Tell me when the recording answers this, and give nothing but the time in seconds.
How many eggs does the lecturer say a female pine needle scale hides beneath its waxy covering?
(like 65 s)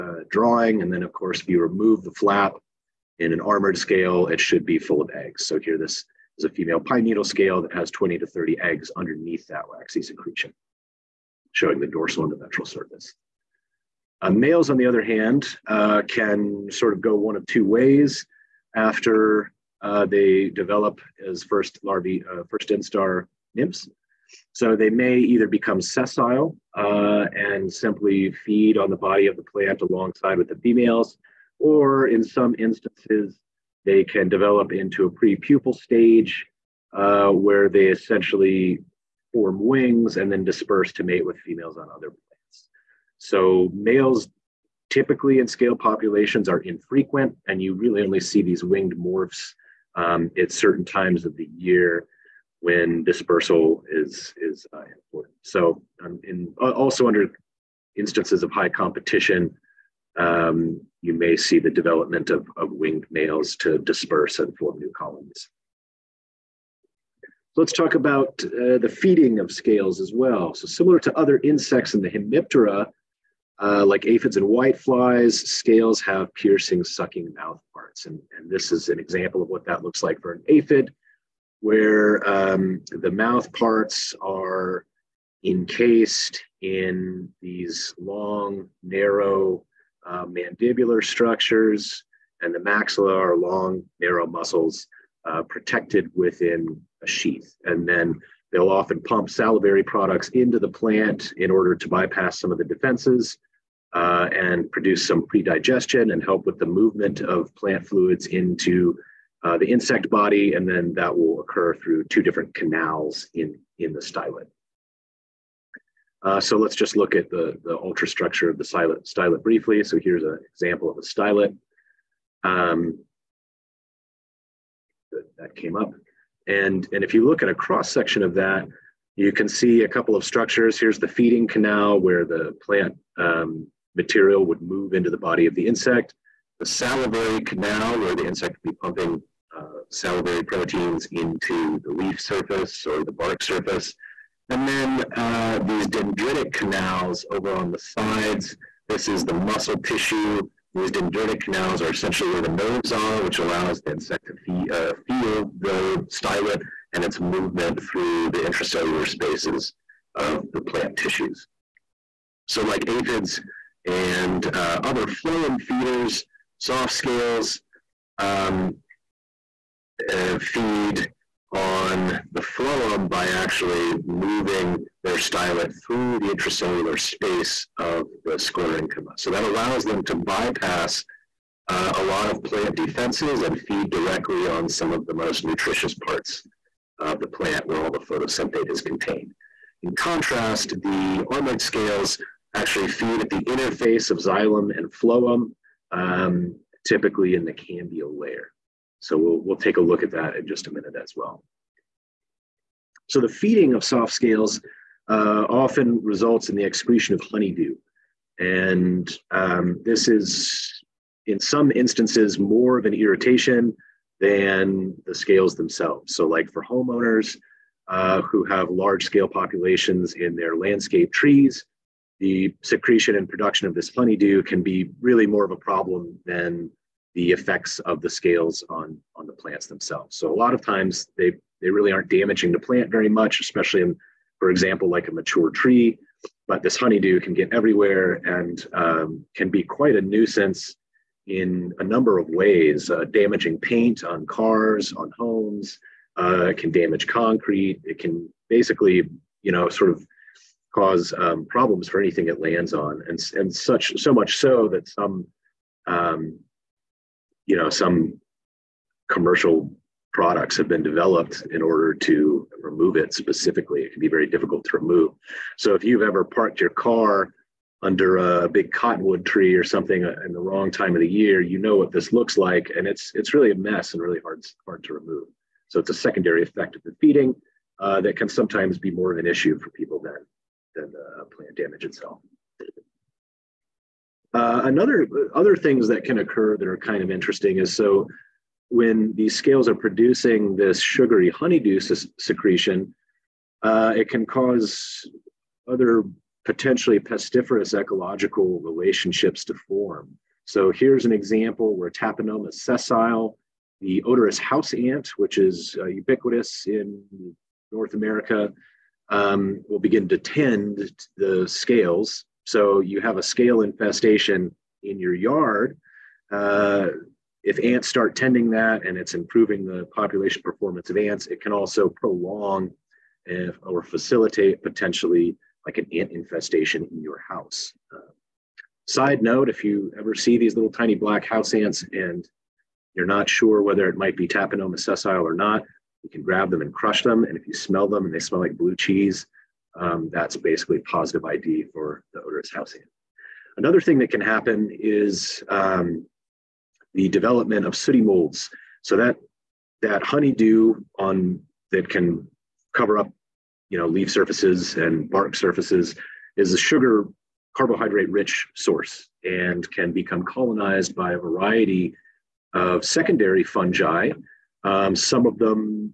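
7 s.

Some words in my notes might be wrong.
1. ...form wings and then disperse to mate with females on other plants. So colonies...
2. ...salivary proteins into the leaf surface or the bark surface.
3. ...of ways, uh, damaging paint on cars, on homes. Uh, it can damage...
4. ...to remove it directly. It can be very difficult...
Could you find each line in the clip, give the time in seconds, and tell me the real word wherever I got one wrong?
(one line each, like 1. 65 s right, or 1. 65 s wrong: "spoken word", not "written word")
1. 39 s wrong: "males", not "colonies"
2. 139 s right
3. 242 s right
4. 261 s wrong: "specifically", not "directly".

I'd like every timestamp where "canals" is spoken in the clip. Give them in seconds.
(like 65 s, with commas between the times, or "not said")
112 s, 131 s, 137 s, 146 s, 151 s.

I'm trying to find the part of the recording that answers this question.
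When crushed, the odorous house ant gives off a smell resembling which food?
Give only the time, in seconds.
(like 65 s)
338 s.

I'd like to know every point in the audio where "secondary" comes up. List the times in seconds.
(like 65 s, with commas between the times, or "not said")
275 s, 362 s.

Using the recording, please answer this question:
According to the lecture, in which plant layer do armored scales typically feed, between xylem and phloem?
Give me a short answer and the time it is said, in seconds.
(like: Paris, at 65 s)
cambial layer, at 197 s.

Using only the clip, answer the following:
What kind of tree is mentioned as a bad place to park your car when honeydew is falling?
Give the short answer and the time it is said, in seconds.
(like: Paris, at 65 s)
cottonwood, at 268 s.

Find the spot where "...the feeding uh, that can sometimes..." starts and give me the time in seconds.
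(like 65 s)
276 s.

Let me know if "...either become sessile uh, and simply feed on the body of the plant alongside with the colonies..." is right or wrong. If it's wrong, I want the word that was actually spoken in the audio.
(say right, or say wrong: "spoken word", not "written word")
wrong: "females", not "colonies".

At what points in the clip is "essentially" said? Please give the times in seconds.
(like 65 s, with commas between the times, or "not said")
37 s, 151 s.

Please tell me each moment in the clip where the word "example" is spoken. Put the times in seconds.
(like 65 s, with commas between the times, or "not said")
78 s, 120 s, 234 s, 301 s.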